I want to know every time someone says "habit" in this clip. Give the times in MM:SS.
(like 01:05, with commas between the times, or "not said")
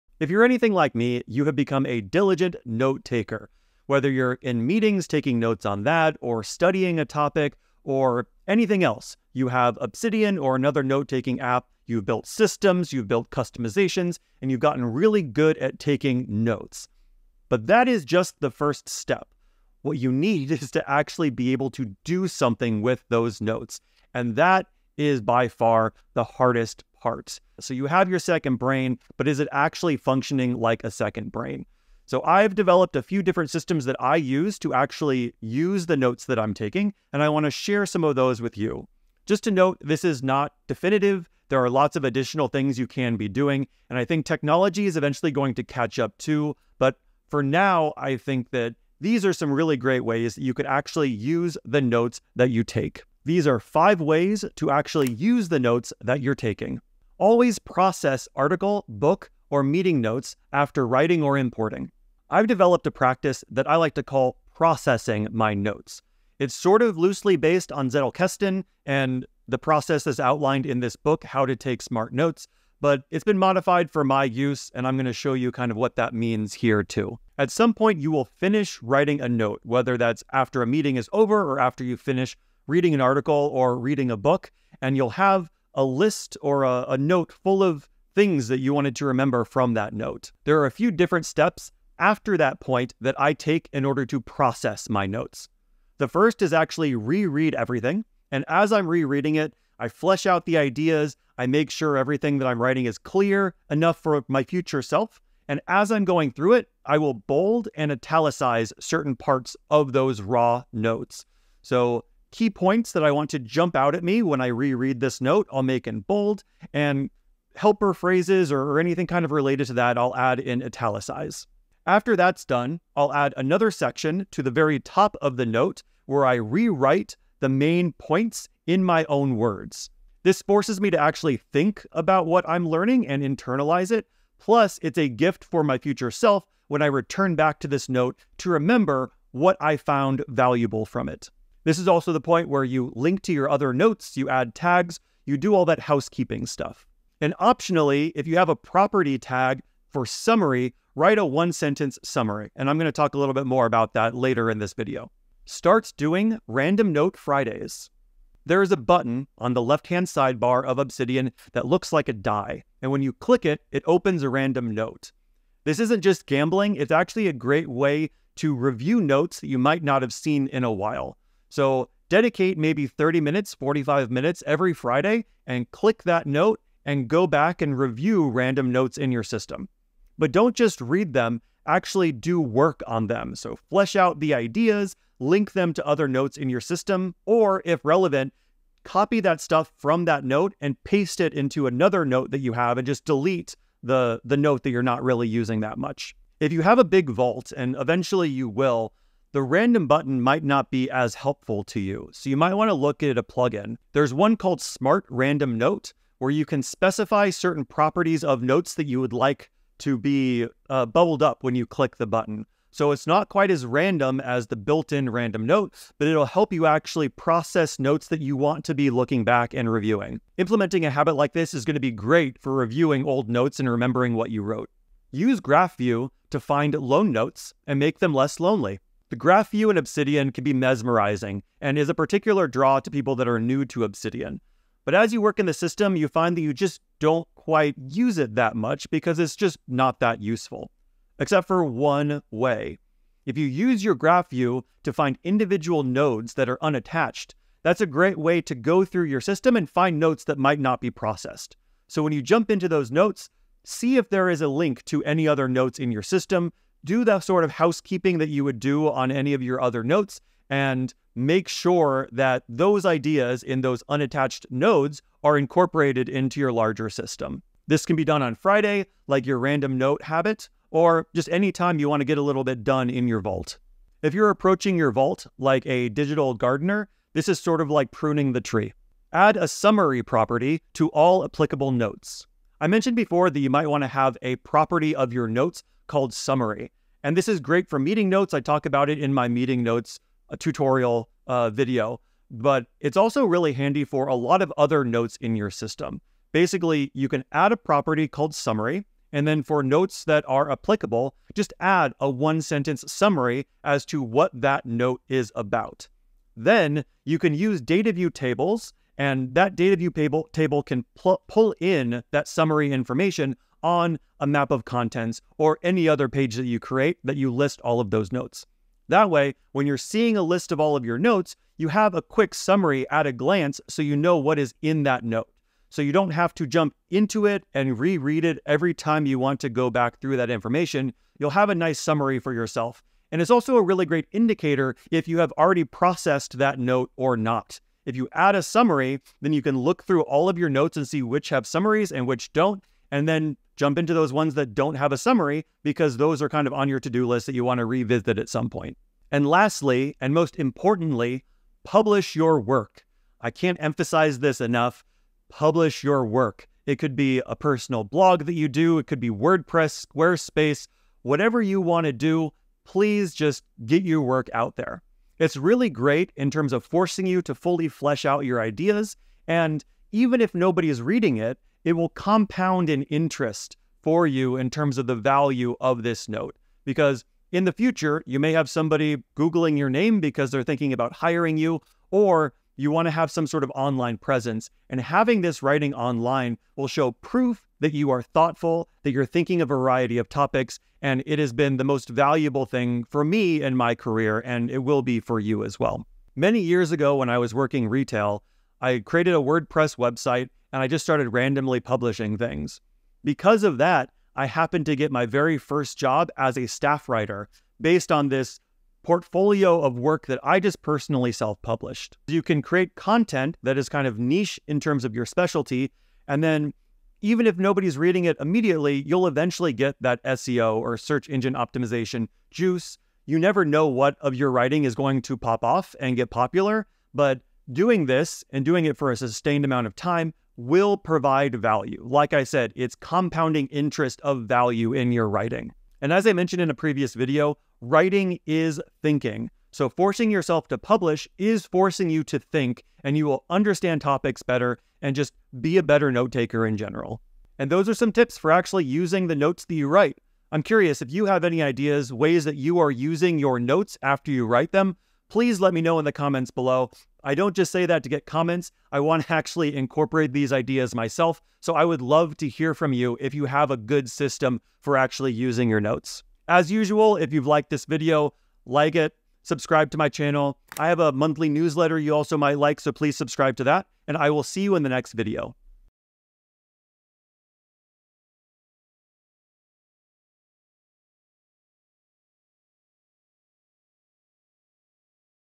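03:40, 04:30.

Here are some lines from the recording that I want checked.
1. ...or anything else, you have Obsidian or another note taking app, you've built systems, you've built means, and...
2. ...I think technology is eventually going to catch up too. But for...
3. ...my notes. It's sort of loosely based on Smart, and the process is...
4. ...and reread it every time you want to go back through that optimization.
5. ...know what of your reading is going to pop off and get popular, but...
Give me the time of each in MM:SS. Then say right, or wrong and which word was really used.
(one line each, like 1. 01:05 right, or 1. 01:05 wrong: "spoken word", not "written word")
1. 00:07 wrong: "customizations", not "means"
2. 00:43 right
3. 01:05 wrong: "Zettelkasten", not "Smart"
4. 05:27 wrong: "information", not "optimization"
5. 07:03 wrong: "writing", not "reading".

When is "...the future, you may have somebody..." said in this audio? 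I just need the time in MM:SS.
06:17.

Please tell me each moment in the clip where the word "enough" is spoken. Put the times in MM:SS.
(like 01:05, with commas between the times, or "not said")
01:43, 05:54.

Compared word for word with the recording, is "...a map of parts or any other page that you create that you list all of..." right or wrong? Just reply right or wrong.
wrong.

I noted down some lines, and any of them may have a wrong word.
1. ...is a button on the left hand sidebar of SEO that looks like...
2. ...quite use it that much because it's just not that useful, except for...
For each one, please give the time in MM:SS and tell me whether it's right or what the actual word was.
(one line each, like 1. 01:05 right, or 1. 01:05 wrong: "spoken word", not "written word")
1. 02:38 wrong: "Obsidian", not "SEO"
2. 03:57 right.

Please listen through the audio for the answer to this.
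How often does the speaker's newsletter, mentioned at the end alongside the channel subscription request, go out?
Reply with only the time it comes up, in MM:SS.
07:50.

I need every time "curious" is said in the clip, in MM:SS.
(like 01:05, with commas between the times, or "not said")
07:30.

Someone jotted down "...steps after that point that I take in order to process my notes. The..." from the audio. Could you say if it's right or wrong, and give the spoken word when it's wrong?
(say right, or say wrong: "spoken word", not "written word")
right.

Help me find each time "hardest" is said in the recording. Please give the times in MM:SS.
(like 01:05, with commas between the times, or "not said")
00:26.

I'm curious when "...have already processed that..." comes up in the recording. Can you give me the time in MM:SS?
05:35.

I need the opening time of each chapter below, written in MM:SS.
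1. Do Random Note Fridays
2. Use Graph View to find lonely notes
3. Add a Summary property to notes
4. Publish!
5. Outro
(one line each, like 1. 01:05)
1. 02:35
2. 03:44
3. 04:38
4. 05:51
5. 07:46.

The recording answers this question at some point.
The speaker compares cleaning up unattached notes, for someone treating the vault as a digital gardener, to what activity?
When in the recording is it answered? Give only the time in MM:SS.
04:37.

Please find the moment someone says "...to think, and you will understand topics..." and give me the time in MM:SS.
07:22.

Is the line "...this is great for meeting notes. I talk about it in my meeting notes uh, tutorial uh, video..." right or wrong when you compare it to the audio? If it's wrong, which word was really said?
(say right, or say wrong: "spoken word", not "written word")
right.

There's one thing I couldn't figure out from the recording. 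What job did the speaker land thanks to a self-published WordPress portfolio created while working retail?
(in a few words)
staff writer.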